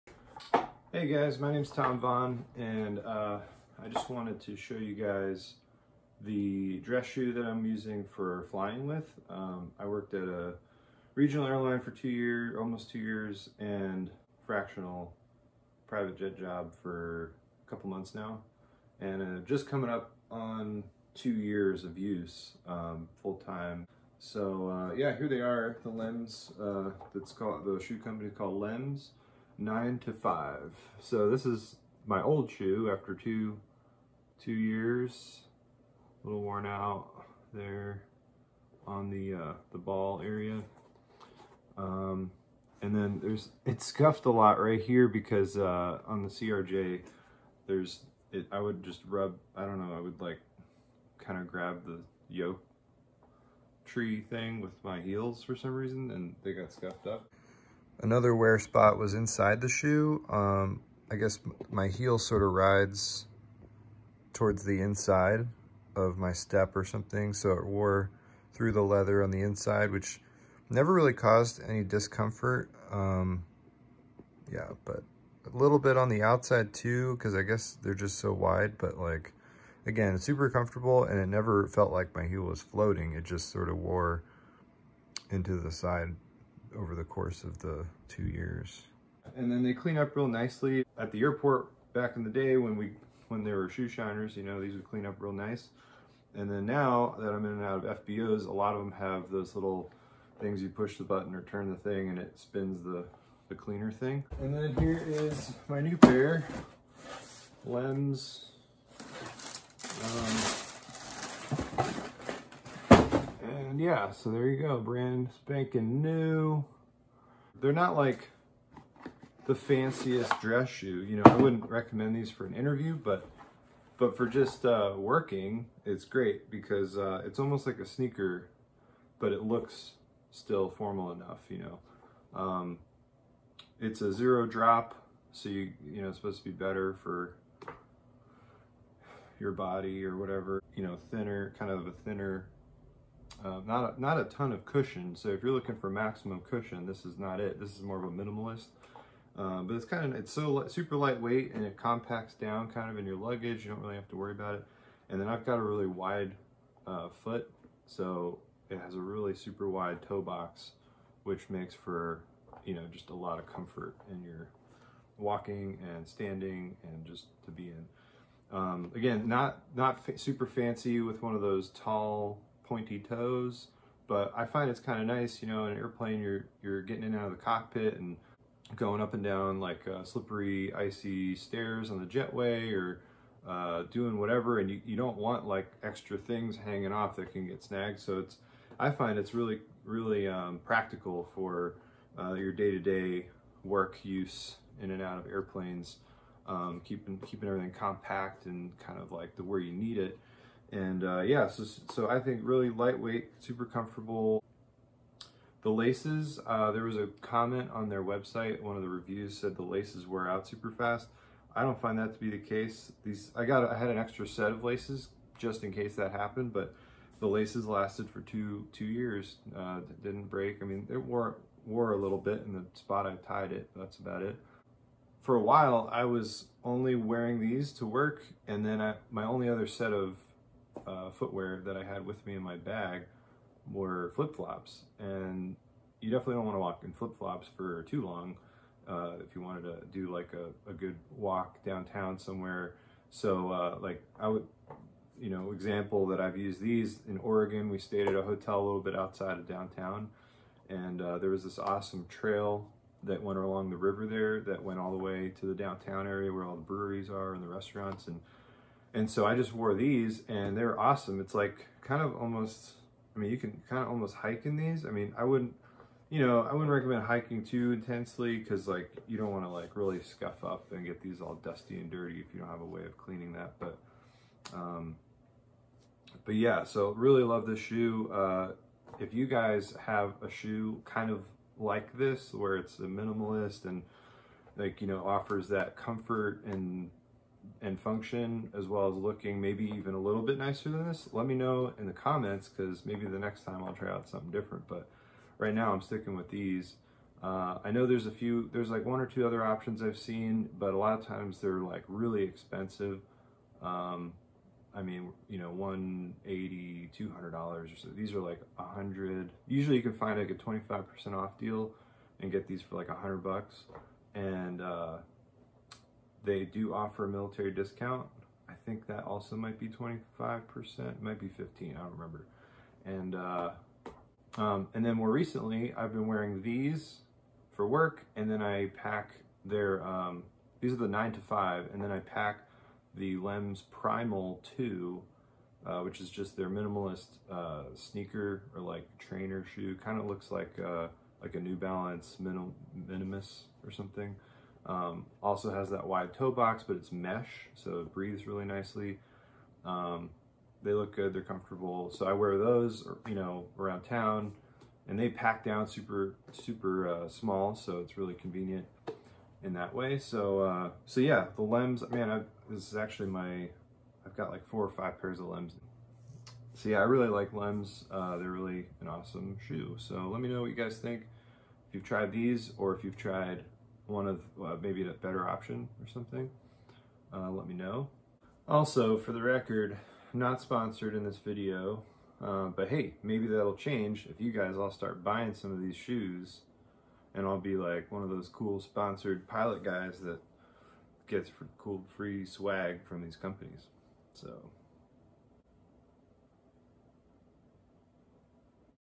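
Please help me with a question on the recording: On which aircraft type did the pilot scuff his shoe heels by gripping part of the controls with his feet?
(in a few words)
CRJ.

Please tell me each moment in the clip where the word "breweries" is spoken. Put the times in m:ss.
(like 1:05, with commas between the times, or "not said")
4:16.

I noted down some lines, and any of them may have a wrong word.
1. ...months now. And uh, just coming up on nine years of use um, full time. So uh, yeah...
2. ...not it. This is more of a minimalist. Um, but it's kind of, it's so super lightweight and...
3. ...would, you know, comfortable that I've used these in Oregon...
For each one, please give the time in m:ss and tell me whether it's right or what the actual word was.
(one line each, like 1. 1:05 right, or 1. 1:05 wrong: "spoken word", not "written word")
1. 0:17 wrong: "two", not "nine"
2. 2:27 right
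3. 4:04 wrong: "example", not "comfortable".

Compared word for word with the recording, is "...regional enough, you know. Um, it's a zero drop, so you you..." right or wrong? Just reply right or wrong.
wrong.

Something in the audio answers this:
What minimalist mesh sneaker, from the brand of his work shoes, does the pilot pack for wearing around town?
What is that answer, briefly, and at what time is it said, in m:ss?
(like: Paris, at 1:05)
Lems Primal 2, at 5:33.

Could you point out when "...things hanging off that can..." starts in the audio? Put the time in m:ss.
3:06.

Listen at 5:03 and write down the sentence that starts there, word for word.
Um, I mean, you know, 180, 200 dollars or so.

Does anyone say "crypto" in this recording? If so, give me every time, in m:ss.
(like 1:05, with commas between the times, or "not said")
not said.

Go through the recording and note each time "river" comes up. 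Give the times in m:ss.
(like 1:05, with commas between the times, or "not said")
4:13.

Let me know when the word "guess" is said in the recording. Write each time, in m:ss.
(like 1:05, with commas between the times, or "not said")
1:01, 1:17.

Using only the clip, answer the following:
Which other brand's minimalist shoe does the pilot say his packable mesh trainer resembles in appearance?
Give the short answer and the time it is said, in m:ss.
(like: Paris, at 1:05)
New Balance, at 5:41.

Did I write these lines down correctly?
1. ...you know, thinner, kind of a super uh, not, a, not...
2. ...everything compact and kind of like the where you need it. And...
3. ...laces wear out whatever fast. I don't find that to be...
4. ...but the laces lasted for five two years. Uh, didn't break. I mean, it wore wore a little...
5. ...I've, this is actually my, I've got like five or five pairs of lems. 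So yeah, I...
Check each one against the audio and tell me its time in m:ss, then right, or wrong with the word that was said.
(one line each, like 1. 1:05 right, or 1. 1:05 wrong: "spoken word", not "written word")
1. 2:20 wrong: "thinner", not "super"
2. 3:17 right
3. 3:29 wrong: "super", not "whatever"
4. 3:36 wrong: "two", not "five"
5. 6:02 wrong: "four", not "five".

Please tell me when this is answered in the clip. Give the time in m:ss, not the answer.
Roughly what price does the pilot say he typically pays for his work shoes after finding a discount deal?
5:12.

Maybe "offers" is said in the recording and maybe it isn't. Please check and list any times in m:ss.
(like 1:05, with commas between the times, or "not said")
4:45, 5:16.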